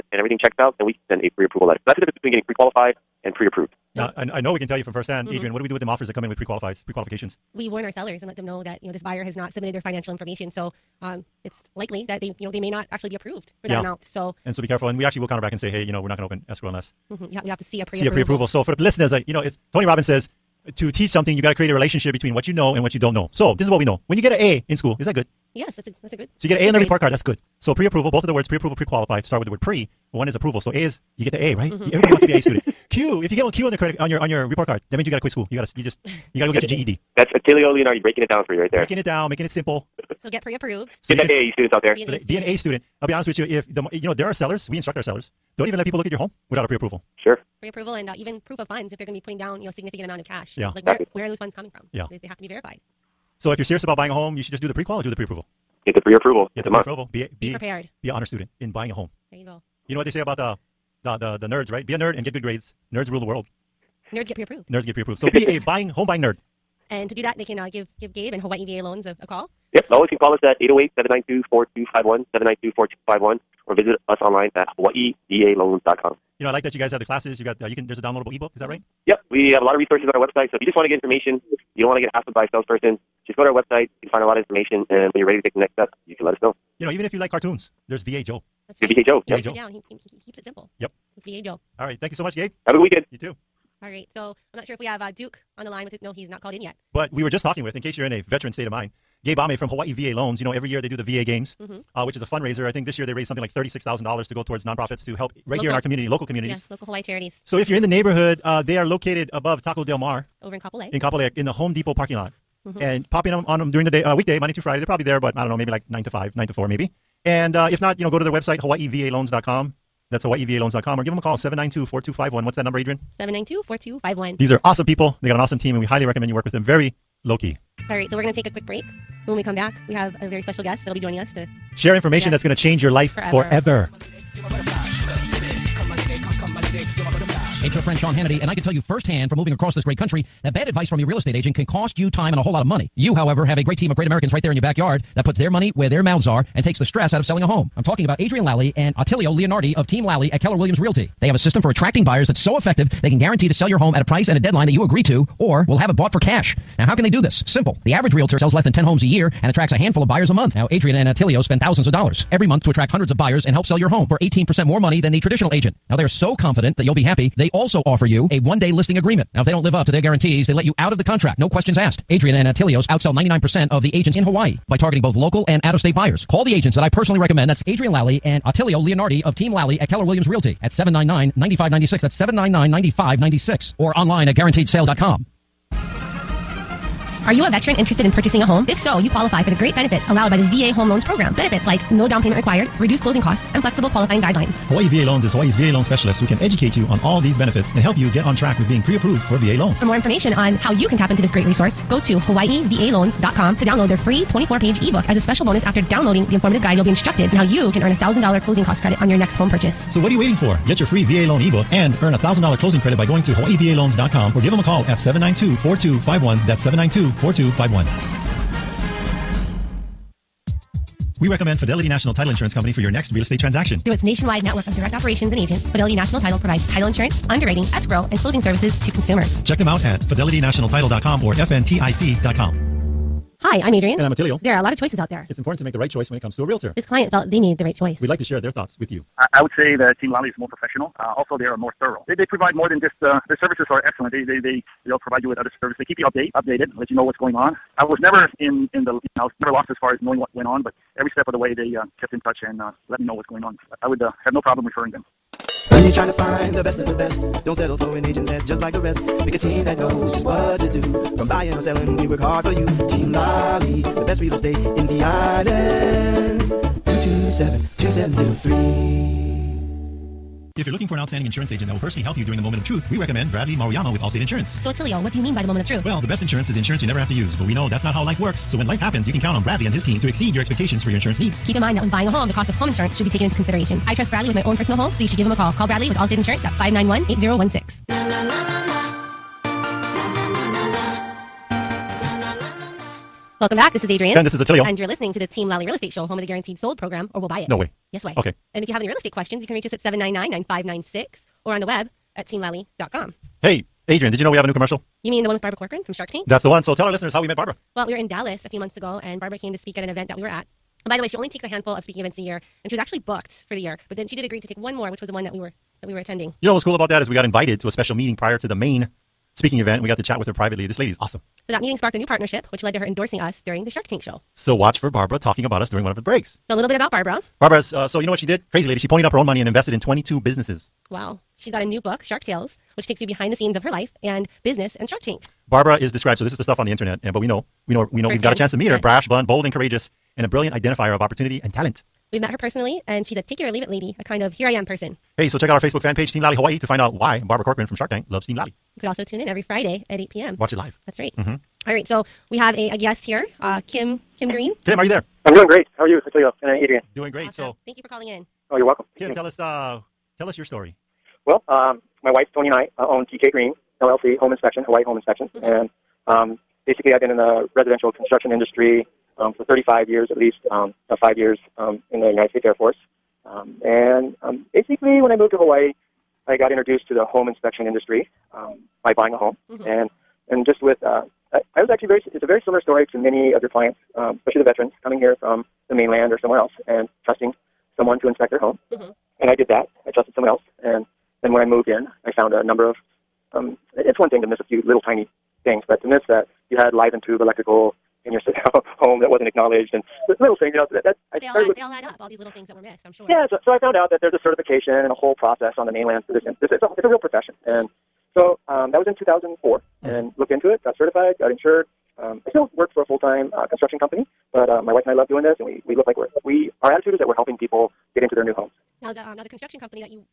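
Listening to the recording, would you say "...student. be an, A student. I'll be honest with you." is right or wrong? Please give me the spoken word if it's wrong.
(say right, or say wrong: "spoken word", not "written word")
right.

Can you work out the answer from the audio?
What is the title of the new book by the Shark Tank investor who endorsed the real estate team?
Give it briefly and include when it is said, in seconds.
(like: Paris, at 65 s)
Shark Tales, at 332 s.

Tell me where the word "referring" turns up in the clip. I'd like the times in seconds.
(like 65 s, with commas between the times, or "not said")
254 s.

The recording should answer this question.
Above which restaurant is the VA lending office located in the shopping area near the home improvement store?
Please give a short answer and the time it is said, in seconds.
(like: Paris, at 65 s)
Taco Del Mar, at 109 s.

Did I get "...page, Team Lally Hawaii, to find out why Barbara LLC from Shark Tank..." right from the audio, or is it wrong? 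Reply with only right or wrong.
wrong.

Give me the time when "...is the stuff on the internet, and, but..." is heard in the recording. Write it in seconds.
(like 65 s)
336 s.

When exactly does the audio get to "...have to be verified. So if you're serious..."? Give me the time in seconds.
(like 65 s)
52 s.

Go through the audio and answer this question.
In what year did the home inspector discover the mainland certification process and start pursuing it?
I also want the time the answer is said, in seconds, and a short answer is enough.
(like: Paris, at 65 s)
2004, at 408 s.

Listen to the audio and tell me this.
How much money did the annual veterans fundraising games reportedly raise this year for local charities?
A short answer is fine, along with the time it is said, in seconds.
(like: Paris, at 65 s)
$36,000, at 103 s.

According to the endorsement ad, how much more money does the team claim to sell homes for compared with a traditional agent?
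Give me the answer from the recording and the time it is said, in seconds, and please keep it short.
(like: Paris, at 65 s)
18%, at 164 s.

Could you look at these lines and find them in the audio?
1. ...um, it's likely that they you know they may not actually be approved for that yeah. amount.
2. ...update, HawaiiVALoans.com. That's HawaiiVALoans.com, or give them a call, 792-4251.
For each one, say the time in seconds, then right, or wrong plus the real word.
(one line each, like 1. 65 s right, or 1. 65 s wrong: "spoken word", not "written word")
1. 11 s right
2. 118 s wrong: "website", not "update".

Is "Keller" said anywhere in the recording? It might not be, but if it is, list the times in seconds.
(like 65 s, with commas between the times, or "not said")
150 s, 179 s.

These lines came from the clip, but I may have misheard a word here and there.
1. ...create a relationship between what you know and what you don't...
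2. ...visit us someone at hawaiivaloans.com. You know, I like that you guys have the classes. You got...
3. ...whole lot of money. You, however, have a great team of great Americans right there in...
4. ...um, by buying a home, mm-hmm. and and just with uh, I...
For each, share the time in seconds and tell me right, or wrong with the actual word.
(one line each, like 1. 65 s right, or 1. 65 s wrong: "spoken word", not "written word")
1. 21 s right
2. 73 s wrong: "online", not "someone"
3. 142 s right
4. 378 s right.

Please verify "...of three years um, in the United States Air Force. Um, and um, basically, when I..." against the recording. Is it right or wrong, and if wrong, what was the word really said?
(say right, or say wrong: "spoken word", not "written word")
wrong: "five", not "three".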